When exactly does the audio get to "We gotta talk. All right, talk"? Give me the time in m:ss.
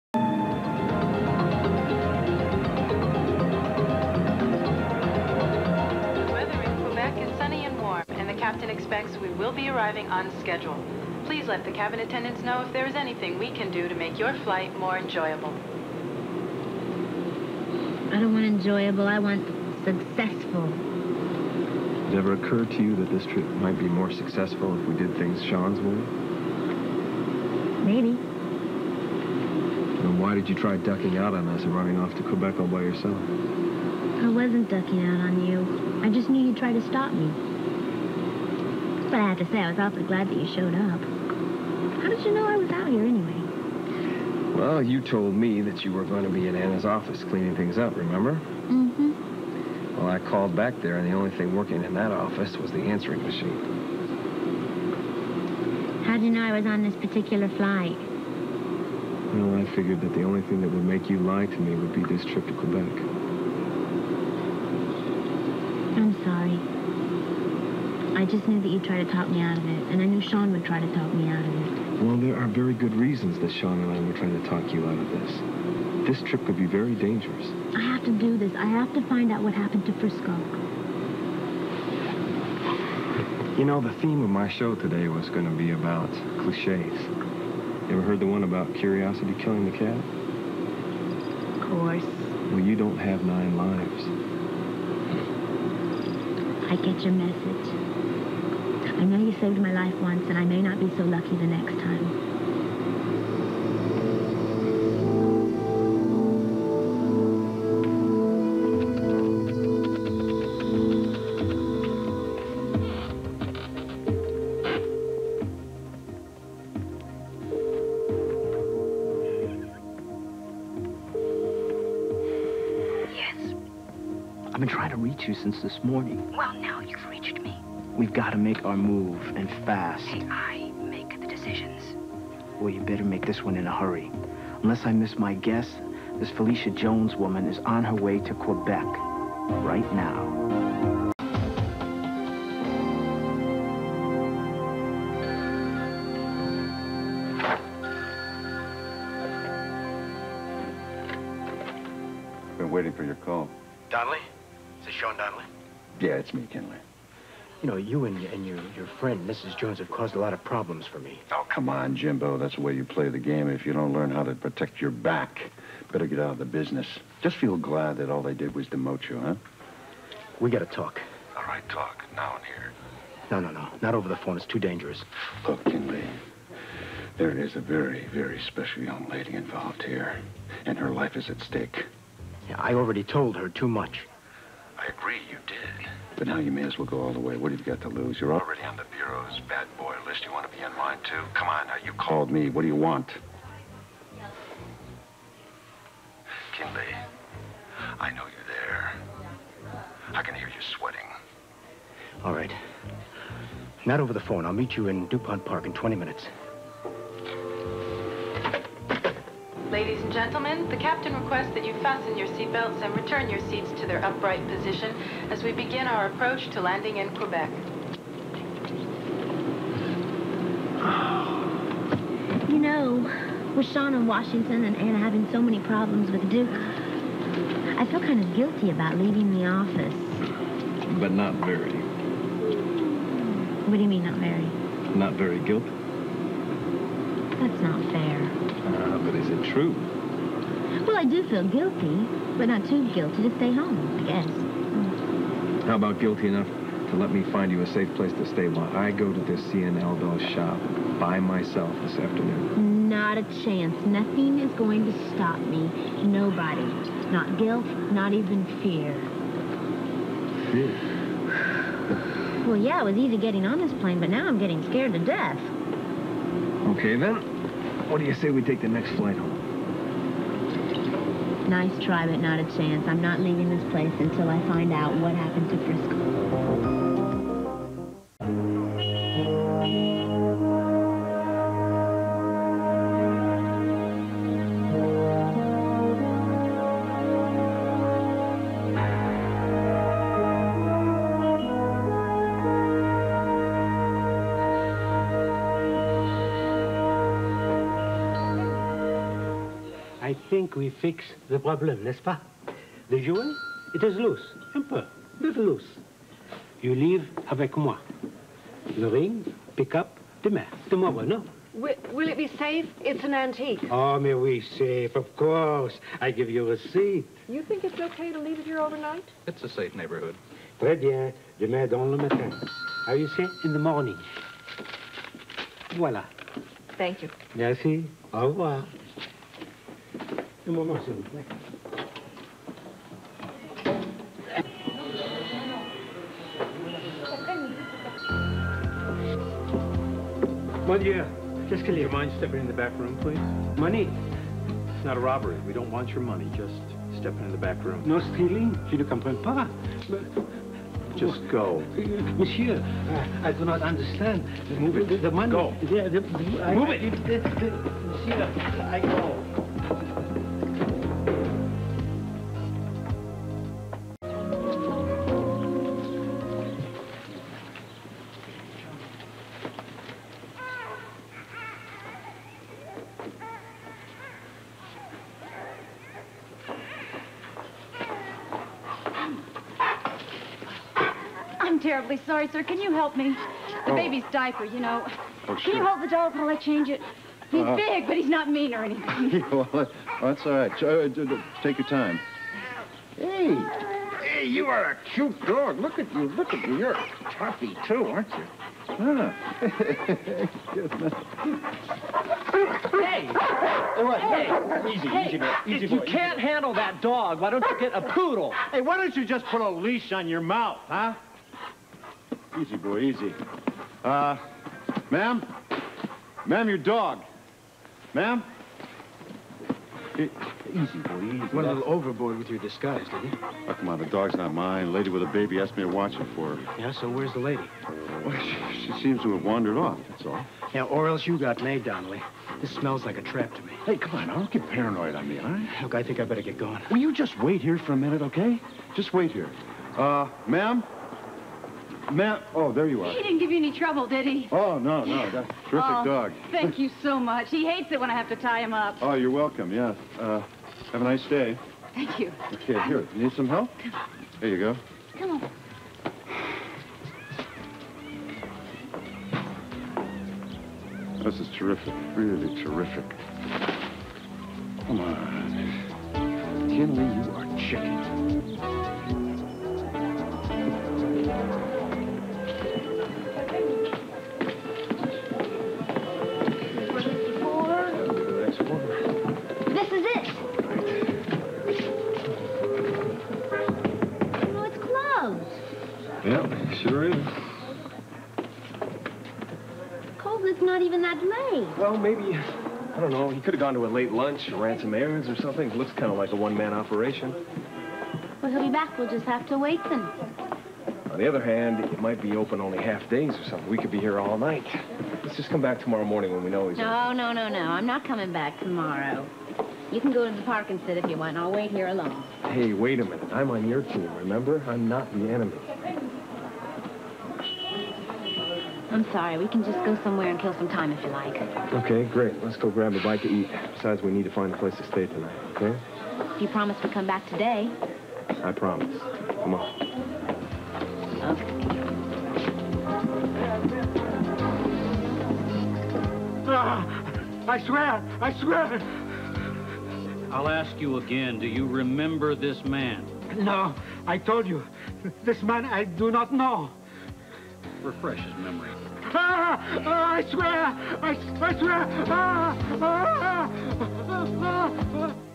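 2:50.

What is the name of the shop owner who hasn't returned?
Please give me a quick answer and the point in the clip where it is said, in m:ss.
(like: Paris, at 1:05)
Colbert, at 8:09.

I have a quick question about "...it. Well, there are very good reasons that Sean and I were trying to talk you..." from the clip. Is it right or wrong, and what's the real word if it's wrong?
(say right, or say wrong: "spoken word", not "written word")
right.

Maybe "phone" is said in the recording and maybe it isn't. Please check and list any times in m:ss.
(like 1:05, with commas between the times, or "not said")
2:54, 3:24.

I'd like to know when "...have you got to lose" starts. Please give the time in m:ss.
3:07.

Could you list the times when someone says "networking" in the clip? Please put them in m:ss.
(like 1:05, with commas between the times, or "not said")
not said.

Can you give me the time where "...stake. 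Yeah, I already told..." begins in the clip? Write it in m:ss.
3:01.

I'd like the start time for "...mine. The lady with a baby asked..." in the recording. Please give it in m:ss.
7:04.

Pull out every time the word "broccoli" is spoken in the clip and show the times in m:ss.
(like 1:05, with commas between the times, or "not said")
not said.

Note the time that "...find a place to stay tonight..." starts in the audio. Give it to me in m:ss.
8:44.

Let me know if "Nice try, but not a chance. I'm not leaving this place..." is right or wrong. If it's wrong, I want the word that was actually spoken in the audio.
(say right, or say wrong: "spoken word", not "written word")
right.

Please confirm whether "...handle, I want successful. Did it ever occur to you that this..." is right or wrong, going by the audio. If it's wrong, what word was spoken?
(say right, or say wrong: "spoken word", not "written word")
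wrong: "enjoyable", not "handle".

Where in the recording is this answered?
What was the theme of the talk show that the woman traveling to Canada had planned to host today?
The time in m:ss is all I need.
1:26.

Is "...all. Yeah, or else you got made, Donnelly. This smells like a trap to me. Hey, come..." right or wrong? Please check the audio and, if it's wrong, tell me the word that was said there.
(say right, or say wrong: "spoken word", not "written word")
right.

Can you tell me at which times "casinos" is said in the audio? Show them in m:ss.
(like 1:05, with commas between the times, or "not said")
not said.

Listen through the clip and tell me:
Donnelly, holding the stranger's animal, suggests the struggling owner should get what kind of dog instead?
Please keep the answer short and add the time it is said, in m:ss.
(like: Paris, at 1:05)
Poodle, at 6:47.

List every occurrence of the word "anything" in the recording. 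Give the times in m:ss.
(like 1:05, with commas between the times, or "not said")
0:12, 6:28.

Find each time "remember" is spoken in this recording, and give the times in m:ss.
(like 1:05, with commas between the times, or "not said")
0:47, 8:33, 9:01.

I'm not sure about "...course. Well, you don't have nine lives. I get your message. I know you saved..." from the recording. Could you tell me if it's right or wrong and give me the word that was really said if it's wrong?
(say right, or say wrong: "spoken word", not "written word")
right.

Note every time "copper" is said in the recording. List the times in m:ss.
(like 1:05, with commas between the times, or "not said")
not said.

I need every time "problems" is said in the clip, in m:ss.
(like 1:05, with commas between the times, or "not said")
2:40, 3:45, 5:01.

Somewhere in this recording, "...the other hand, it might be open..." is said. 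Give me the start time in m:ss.
8:20.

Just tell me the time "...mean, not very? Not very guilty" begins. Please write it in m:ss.
3:53.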